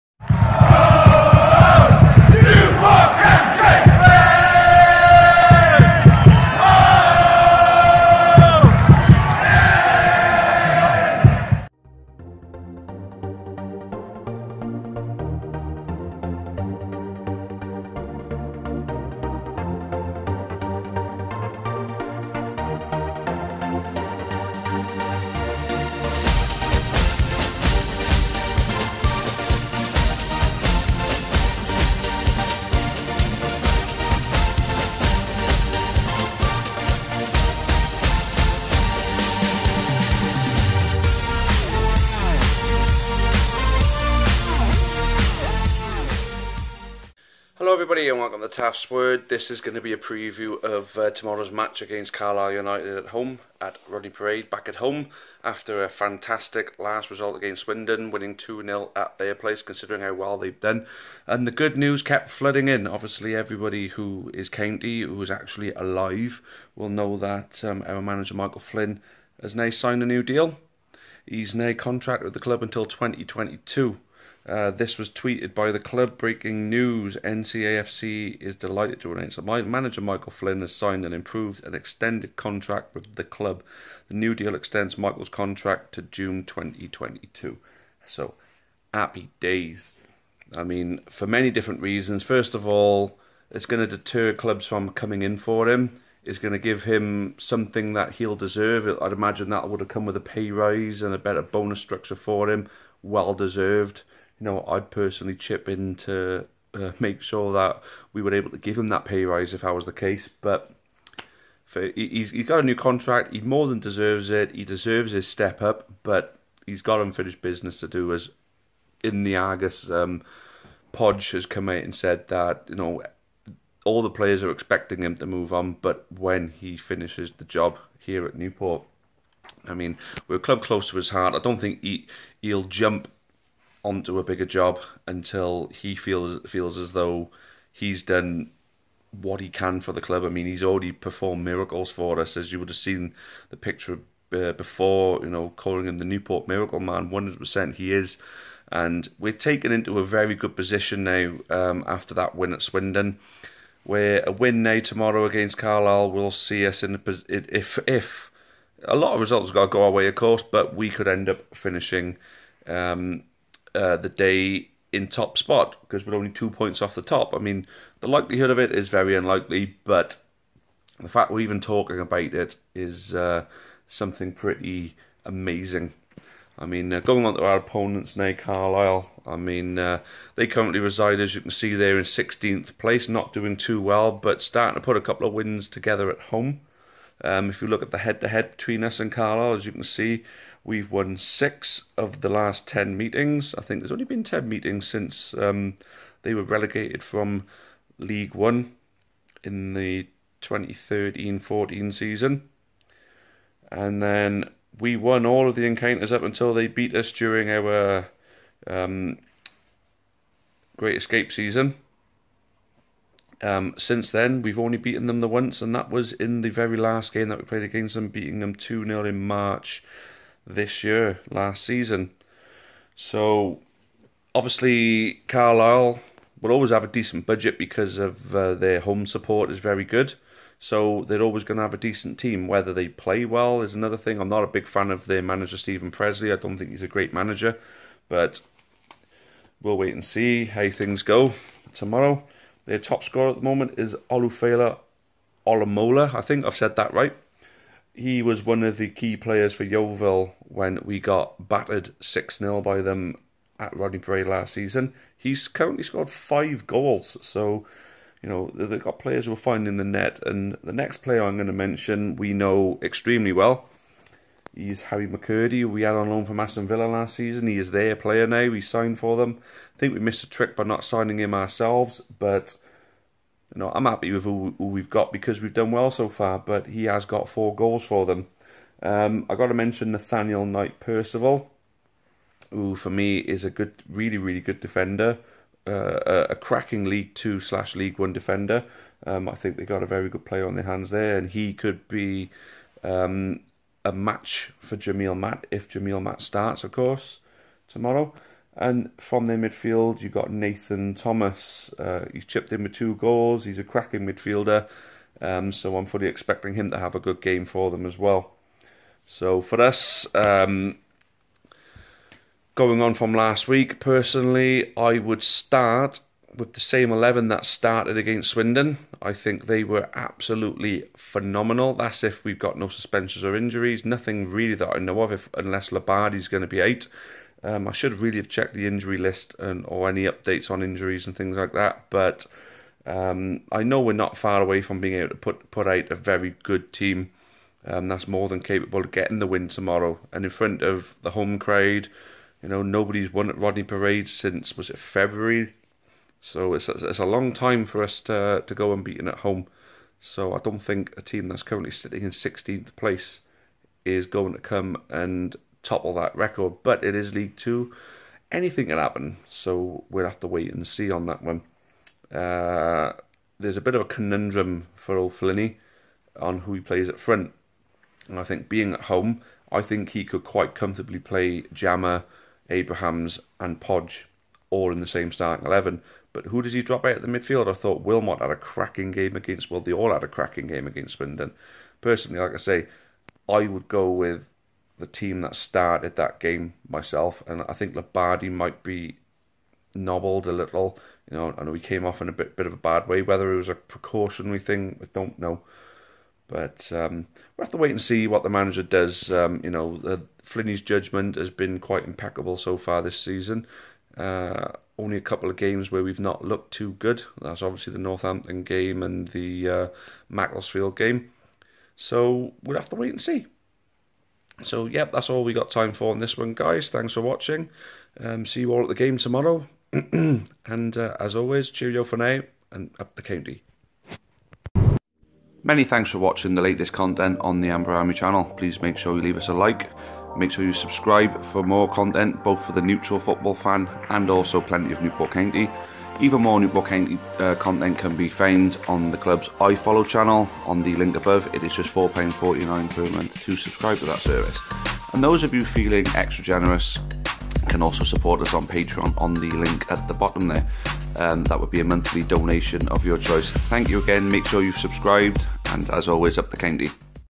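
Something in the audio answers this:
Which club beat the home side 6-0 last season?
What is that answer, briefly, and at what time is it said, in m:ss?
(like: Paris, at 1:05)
Yeovil, at 4:09.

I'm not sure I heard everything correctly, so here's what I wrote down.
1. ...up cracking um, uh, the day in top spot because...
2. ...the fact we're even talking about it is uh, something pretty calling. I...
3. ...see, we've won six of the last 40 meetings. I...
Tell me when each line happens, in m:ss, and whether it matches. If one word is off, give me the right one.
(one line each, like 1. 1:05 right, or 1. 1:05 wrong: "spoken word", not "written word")
1. 2:41 wrong: "finishing", not "cracking"
2. 2:50 wrong: "amazing", not "calling"
3. 3:09 wrong: "10", not "40".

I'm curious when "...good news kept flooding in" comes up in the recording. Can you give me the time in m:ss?
1:01.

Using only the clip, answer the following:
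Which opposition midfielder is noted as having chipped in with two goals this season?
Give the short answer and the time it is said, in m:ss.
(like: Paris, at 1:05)
Nathan Thomas, at 5:00.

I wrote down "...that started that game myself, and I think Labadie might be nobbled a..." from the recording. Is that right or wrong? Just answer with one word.
right.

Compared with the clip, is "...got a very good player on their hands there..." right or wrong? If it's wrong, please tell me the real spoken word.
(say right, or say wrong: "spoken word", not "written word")
right.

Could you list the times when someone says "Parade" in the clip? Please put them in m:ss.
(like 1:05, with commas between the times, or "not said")
0:54, 4:13, 5:43.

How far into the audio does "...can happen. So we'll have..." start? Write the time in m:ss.
5:58.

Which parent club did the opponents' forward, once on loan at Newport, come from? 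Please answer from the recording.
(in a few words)
Aston Villa.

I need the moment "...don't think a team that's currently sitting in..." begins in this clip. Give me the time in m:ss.
5:50.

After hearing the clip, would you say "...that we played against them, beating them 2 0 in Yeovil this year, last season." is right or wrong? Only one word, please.
wrong.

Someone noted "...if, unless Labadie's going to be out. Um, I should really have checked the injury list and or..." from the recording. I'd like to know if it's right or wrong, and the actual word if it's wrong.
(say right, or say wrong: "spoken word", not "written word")
right.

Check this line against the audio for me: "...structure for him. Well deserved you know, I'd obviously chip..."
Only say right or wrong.
wrong.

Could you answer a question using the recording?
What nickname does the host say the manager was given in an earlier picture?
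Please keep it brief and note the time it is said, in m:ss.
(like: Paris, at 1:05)
Newport Miracle Man, at 2:26.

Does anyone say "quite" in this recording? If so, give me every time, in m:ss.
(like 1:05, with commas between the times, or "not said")
6:10, 6:41.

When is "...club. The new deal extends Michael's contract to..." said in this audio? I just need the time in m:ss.
1:23.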